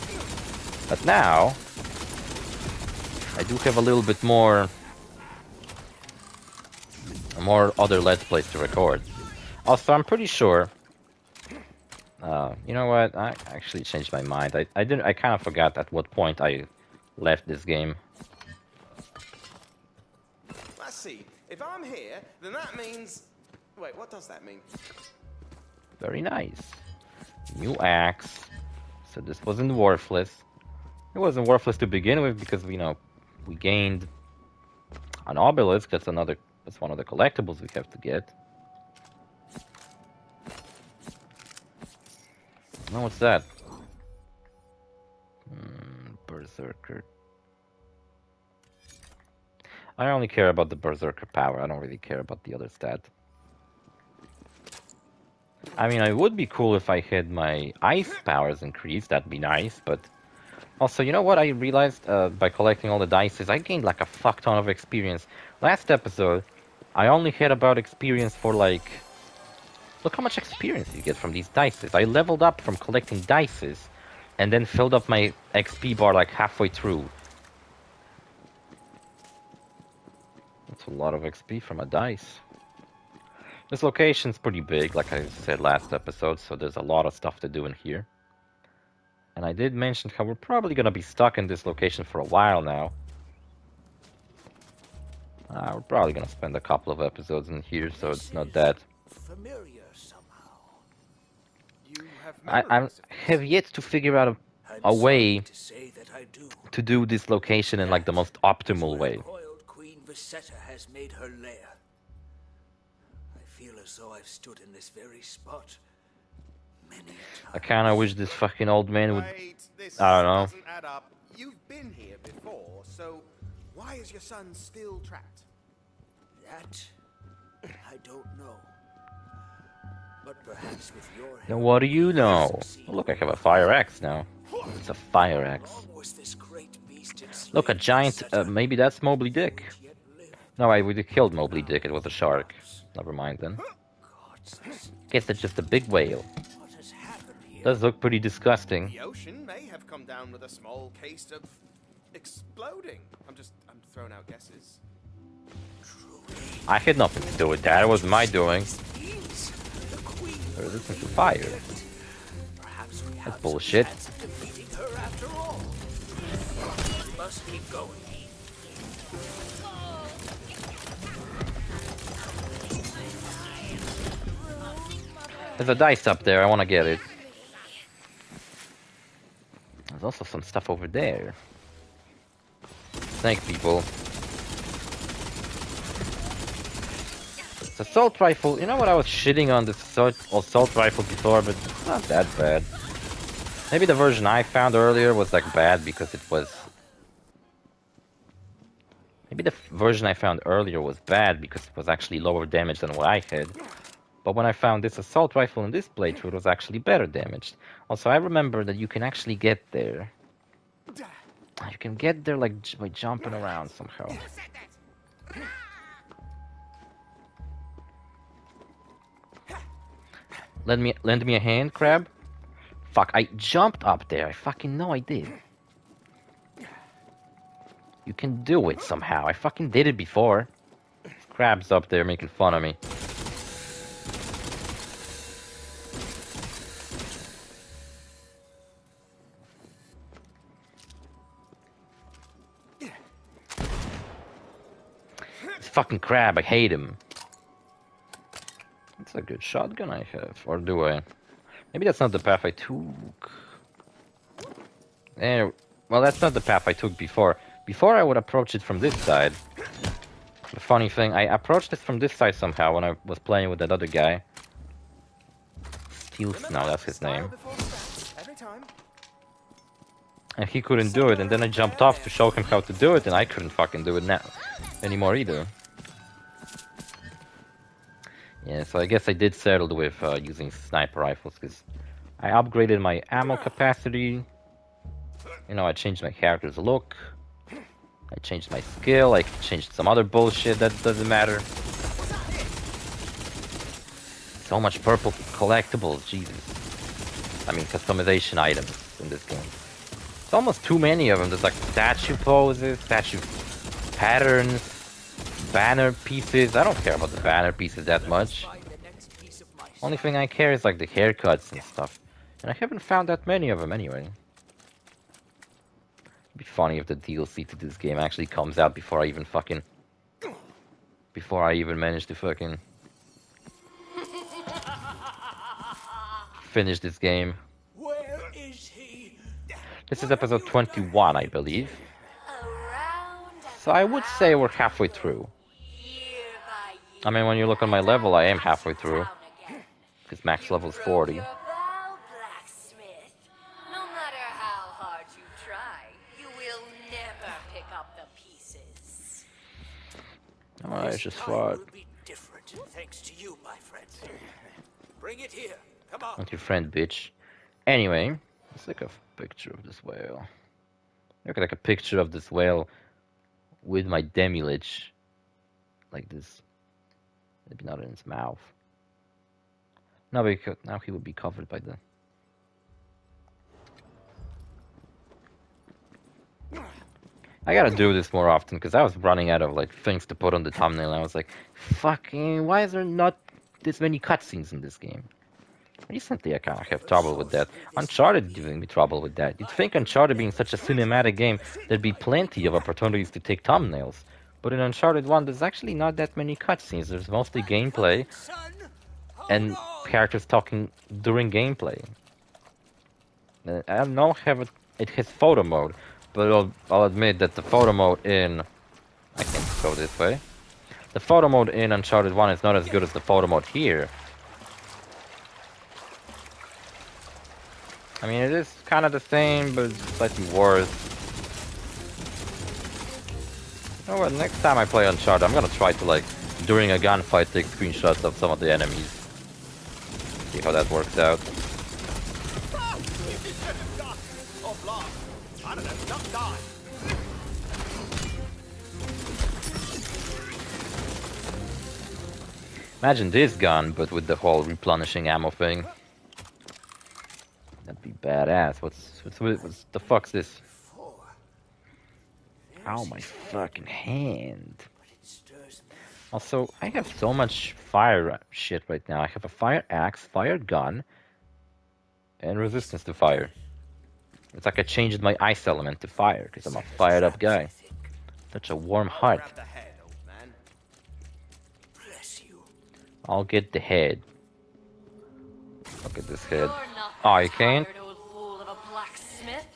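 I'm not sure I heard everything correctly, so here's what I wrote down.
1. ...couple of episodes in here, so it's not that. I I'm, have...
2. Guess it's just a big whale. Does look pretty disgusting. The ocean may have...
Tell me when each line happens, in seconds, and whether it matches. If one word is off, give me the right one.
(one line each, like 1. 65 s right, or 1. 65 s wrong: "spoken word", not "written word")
1. 96 s right
2. 145 s right.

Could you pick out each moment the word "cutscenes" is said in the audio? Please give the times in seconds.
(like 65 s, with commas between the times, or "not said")
383 s, 396 s.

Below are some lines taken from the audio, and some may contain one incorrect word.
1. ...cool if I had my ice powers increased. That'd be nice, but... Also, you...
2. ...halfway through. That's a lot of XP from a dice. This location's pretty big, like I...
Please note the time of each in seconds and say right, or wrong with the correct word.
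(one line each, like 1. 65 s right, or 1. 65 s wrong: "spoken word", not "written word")
1. 56 s right
2. 76 s right.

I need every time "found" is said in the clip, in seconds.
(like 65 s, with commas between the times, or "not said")
194 s, 200 s, 204 s, 312 s.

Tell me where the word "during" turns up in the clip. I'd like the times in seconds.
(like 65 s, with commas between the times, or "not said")
401 s, 426 s.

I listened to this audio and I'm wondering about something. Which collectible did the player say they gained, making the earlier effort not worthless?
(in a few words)
Obelisk.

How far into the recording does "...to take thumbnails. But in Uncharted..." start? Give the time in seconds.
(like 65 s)
393 s.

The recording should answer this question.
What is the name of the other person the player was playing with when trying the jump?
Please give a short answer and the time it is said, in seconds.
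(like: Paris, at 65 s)
Steels, at 265 s.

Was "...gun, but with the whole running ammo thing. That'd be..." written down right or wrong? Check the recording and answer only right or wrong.
wrong.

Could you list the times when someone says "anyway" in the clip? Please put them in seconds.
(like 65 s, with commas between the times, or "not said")
313 s, 357 s.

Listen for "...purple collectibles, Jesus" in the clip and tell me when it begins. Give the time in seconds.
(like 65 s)
294 s.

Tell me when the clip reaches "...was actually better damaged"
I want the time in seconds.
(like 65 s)
206 s.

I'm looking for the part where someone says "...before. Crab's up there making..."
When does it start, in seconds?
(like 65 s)
229 s.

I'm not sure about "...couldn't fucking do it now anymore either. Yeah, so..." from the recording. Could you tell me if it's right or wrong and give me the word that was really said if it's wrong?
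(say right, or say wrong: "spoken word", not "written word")
right.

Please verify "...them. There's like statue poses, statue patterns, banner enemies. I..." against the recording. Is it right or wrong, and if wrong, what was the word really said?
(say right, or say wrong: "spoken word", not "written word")
wrong: "pieces", not "enemies".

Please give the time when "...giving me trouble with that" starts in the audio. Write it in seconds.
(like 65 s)
388 s.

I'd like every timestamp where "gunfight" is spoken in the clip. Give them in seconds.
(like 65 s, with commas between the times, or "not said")
426 s.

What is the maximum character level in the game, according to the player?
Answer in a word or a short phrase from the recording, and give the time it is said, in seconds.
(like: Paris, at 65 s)
40, at 340 s.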